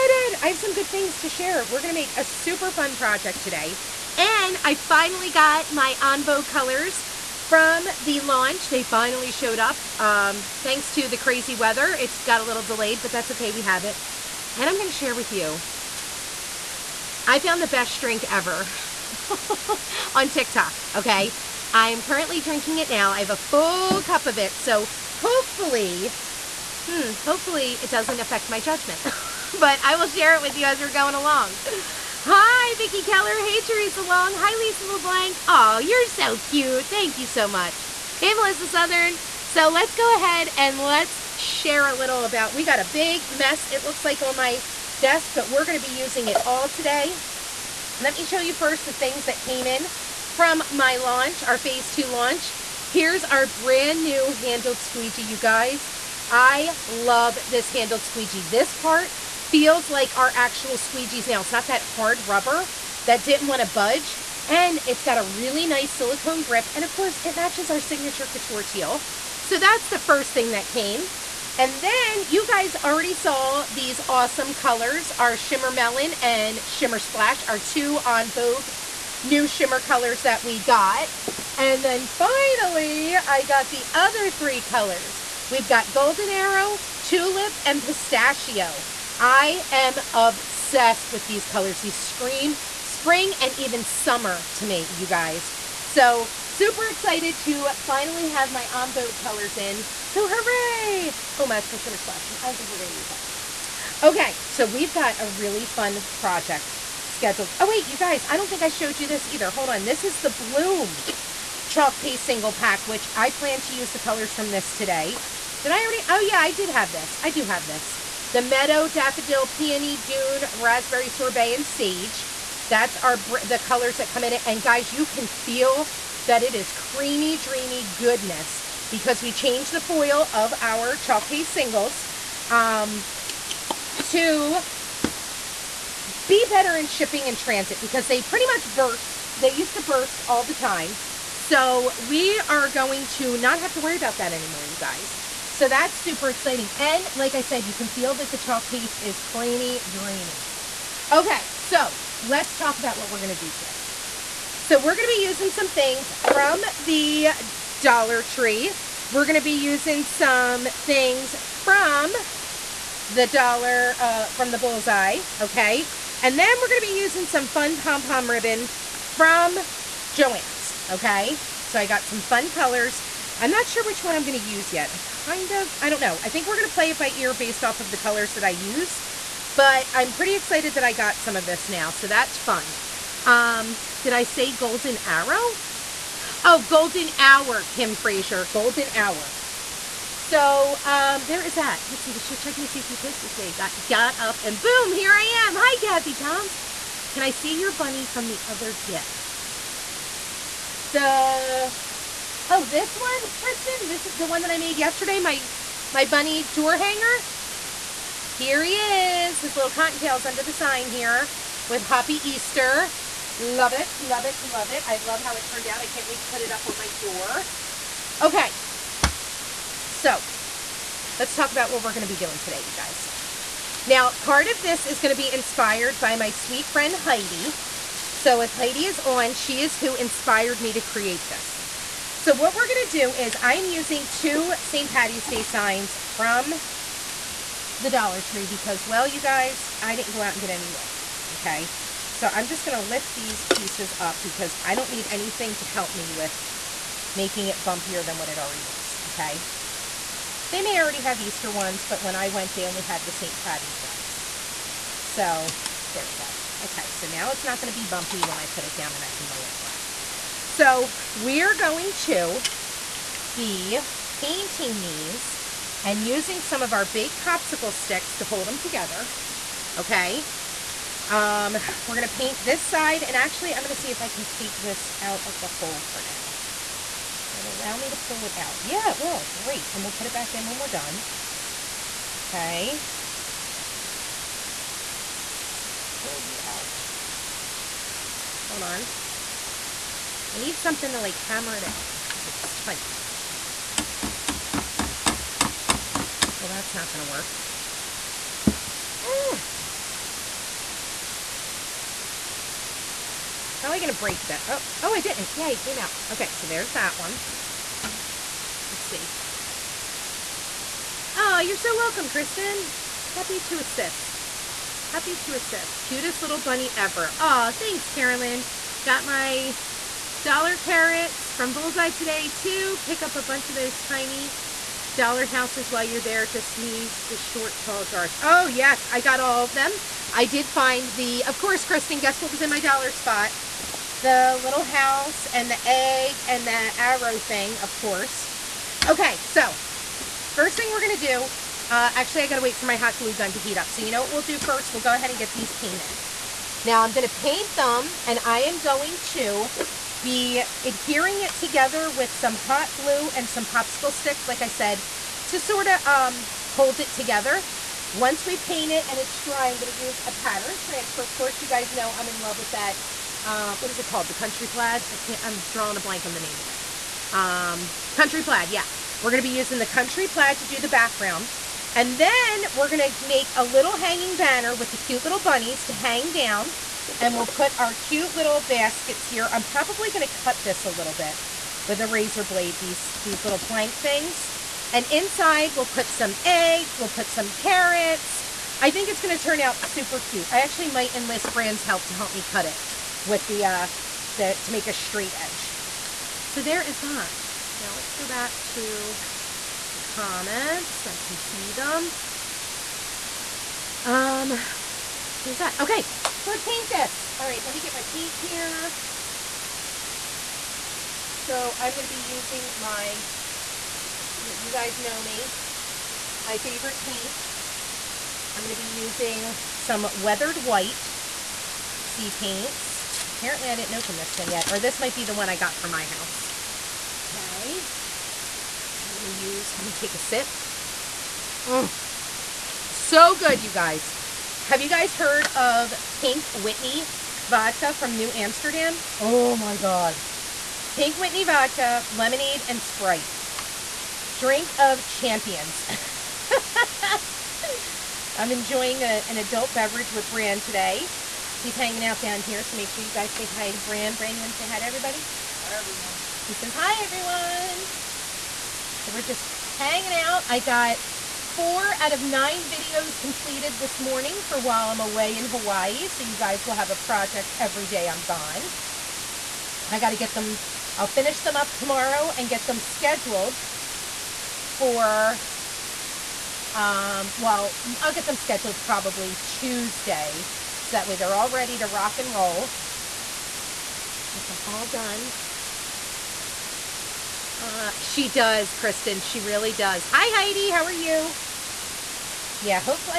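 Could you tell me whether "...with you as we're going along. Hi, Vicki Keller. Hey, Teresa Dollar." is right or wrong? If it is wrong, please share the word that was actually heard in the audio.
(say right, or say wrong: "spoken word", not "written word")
wrong: "Long", not "Dollar".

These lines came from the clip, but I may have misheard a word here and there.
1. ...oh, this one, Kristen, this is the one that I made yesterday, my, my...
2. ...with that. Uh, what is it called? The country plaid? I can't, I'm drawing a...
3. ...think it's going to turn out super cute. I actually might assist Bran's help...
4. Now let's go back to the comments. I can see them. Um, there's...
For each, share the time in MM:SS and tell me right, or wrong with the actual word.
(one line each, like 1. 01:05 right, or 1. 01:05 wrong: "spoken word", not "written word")
1. 03:22 right
2. 06:02 right
3. 06:28 wrong: "enlist", not "assist"
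4. 06:37 right.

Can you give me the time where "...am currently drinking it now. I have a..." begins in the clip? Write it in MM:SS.
00:21.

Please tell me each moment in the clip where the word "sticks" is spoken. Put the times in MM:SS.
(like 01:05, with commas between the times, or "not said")
04:27, 05:53.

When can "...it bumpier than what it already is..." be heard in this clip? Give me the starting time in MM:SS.
04:07.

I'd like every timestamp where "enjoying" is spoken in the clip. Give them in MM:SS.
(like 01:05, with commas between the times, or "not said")
07:28.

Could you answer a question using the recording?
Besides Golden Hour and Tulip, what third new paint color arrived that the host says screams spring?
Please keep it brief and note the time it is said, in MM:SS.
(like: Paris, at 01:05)
Pistachio, at 01:27.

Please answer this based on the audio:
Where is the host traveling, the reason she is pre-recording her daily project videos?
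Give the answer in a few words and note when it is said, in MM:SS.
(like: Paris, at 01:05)
Hawaii, at 07:45.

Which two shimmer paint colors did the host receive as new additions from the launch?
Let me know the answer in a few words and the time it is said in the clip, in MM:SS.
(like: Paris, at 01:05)
Shimmer Melon and Shimmer Splash, at 01:15.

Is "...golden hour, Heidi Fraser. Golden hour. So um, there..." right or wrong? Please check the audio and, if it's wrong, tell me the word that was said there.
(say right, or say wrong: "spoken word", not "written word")
wrong: "Kim", not "Heidi".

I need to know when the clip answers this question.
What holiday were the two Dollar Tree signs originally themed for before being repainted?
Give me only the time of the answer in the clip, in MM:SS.
03:54.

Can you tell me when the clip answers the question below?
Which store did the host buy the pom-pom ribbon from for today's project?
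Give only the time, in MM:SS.
02:50.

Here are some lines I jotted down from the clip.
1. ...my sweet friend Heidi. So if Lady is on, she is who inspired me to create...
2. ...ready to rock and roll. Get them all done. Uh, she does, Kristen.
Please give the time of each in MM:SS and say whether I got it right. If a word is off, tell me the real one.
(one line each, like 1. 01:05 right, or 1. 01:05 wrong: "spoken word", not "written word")
1. 03:46 right
2. 08:01 right.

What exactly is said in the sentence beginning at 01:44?
Okay, so we've got a really fun project scheduled.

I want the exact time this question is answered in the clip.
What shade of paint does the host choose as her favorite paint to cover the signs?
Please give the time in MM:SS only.
06:59.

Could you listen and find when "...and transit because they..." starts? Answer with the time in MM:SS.
02:17.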